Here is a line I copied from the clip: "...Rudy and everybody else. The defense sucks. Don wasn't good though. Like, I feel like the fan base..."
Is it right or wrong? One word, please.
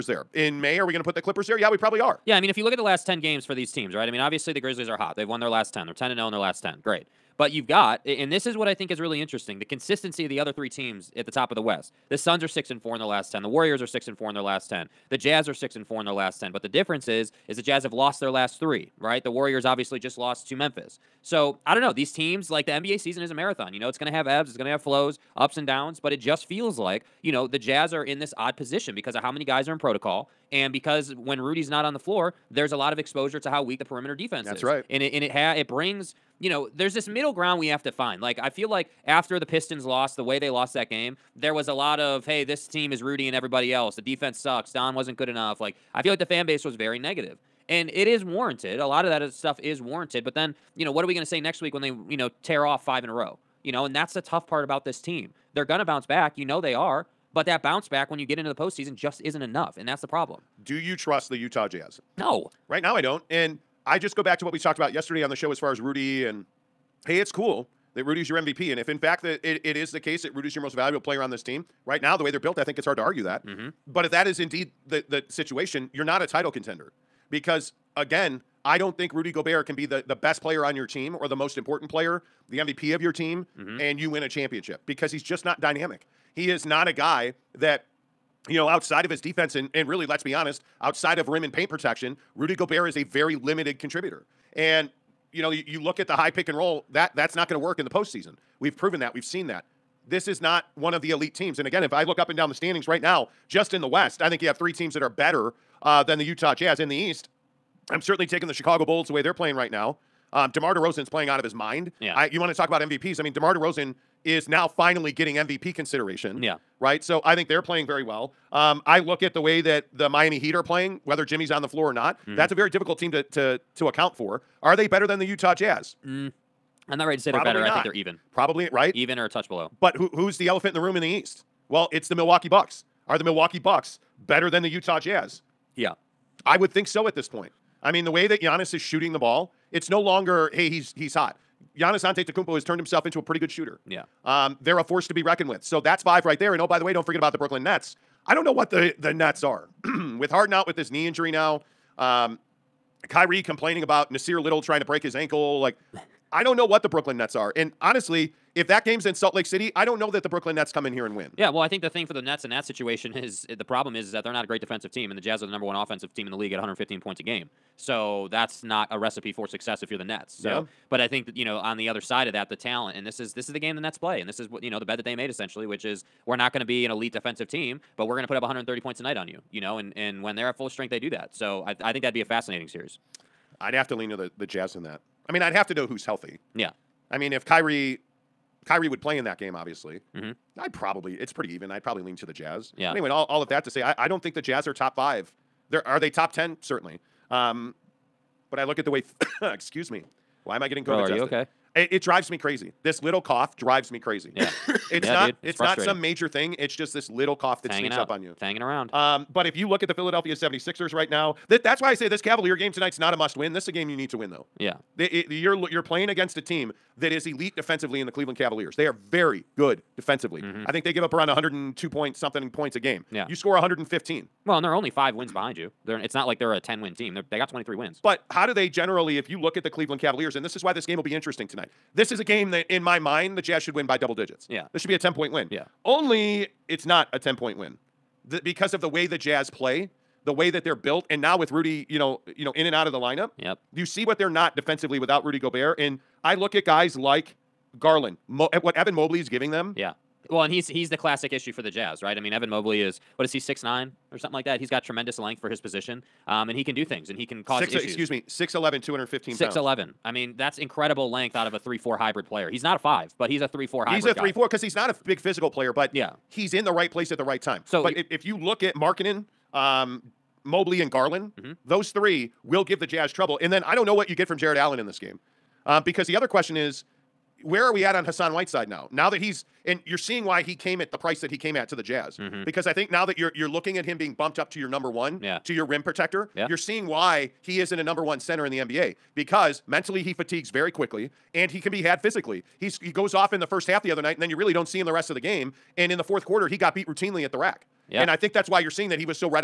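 wrong.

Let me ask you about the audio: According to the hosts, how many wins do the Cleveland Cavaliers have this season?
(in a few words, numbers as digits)
23.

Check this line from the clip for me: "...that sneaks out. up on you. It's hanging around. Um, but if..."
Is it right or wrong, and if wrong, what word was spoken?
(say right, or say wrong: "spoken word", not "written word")
right.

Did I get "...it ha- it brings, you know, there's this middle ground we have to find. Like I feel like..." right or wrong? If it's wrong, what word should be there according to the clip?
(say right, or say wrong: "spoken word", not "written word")
right.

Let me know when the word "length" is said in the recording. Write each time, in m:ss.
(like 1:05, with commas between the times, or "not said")
4:15, 4:21.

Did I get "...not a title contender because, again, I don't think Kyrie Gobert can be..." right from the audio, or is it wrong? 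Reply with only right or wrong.
wrong.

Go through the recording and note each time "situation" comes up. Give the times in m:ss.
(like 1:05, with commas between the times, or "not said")
1:15, 2:42.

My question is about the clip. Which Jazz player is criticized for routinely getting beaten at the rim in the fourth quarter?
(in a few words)
Hassan Whiteside.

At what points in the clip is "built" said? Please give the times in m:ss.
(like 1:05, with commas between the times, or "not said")
1:12, 4:00.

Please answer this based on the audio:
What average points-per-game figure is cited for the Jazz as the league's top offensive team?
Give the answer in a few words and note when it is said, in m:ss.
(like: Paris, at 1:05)
115, at 2:46.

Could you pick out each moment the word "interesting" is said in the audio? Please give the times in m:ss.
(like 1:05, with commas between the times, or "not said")
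0:09, 3:51.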